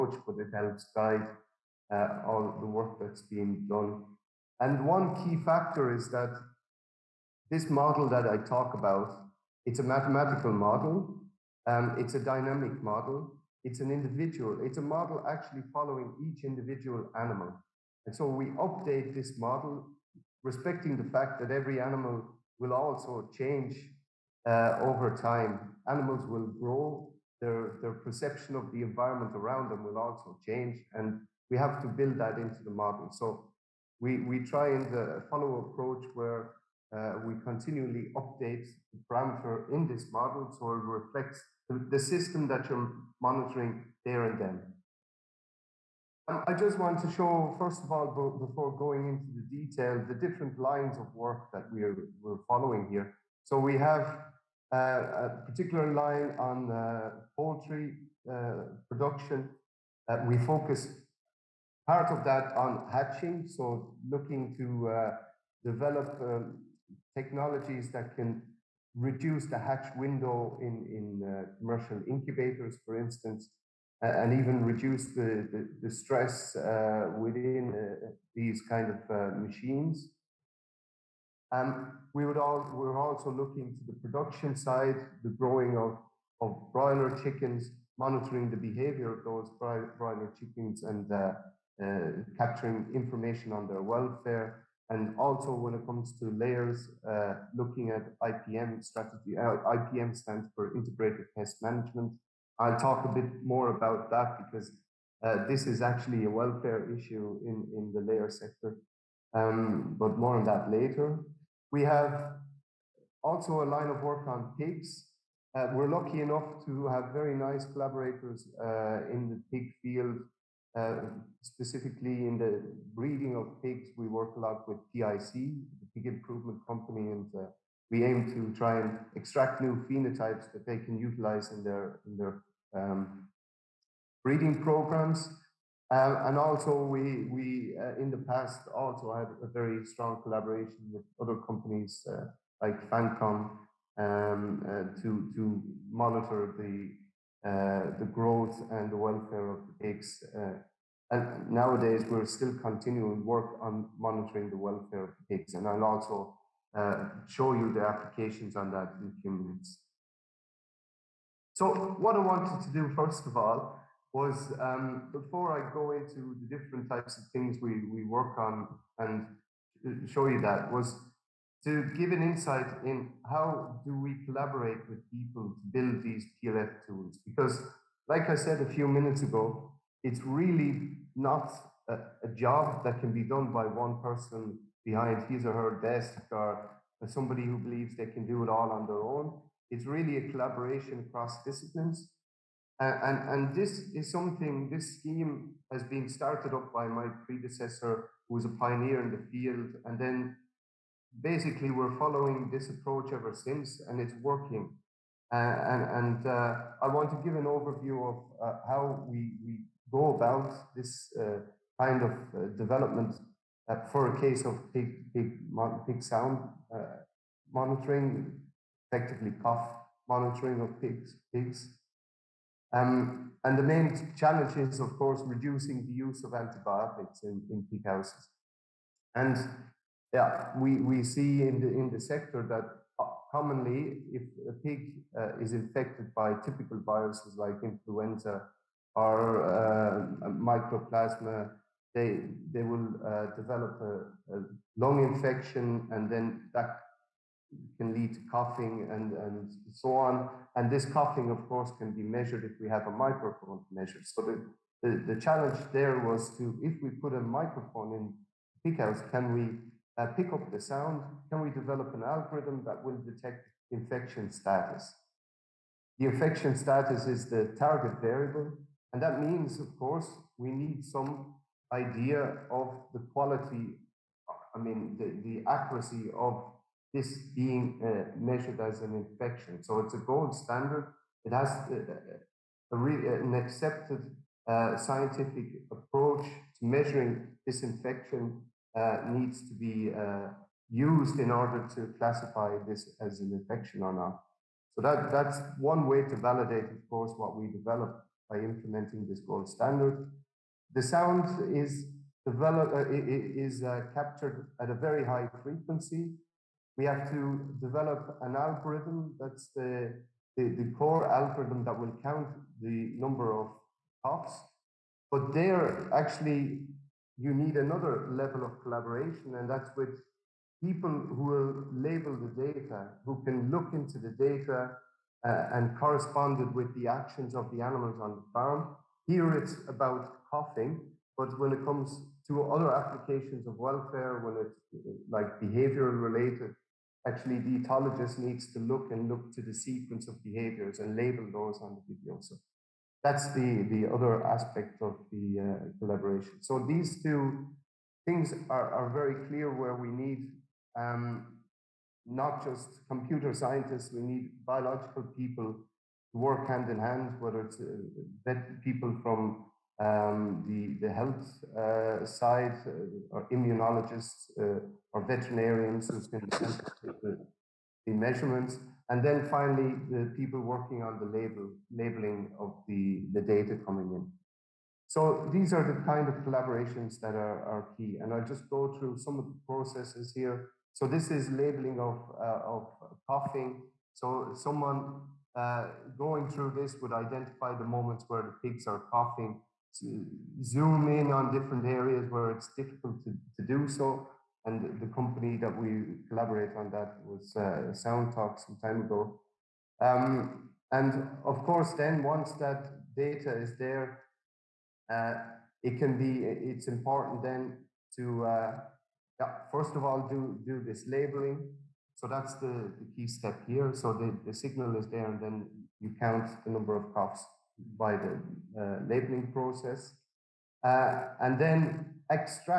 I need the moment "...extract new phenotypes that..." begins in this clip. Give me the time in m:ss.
2:09.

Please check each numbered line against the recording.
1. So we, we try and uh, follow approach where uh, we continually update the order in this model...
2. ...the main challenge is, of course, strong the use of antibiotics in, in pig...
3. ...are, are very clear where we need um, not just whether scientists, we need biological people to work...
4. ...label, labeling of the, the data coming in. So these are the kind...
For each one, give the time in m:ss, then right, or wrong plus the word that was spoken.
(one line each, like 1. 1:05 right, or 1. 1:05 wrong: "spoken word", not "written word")
1. 0:33 wrong: "parameter", not "order"
2. 3:43 wrong: "reducing", not "strong"
3. 5:48 wrong: "computer", not "whether"
4. 6:11 right.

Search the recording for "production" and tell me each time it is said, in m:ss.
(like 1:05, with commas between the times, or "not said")
0:58, 1:24.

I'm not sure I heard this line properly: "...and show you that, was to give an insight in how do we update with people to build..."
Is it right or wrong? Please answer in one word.
wrong.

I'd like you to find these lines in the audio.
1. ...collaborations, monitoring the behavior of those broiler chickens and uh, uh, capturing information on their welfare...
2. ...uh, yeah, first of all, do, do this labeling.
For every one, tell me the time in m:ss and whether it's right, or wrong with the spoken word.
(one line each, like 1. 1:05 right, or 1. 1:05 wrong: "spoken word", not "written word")
1. 1:27 wrong: "chickens", not "collaborations"
2. 6:48 right.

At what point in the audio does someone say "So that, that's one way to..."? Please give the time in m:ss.
4:54.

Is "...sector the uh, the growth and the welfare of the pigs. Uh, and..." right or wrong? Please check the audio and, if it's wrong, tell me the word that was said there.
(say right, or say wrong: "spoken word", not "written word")
wrong: "monitor", not "sector".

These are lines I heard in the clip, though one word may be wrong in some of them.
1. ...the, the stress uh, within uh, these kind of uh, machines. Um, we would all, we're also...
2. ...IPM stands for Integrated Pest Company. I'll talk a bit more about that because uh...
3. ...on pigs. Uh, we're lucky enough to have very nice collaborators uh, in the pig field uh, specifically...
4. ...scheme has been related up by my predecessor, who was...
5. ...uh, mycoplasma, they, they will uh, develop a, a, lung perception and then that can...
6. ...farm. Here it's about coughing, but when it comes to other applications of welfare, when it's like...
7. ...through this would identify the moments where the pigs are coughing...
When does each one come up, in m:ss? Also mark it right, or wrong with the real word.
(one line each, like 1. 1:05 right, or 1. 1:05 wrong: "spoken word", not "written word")
1. 1:15 right
2. 1:39 wrong: "Management", not "Company"
3. 1:54 right
4. 3:14 wrong: "started", not "related"
5. 3:59 wrong: "infection", not "perception"
6. 5:28 right
7. 6:26 right.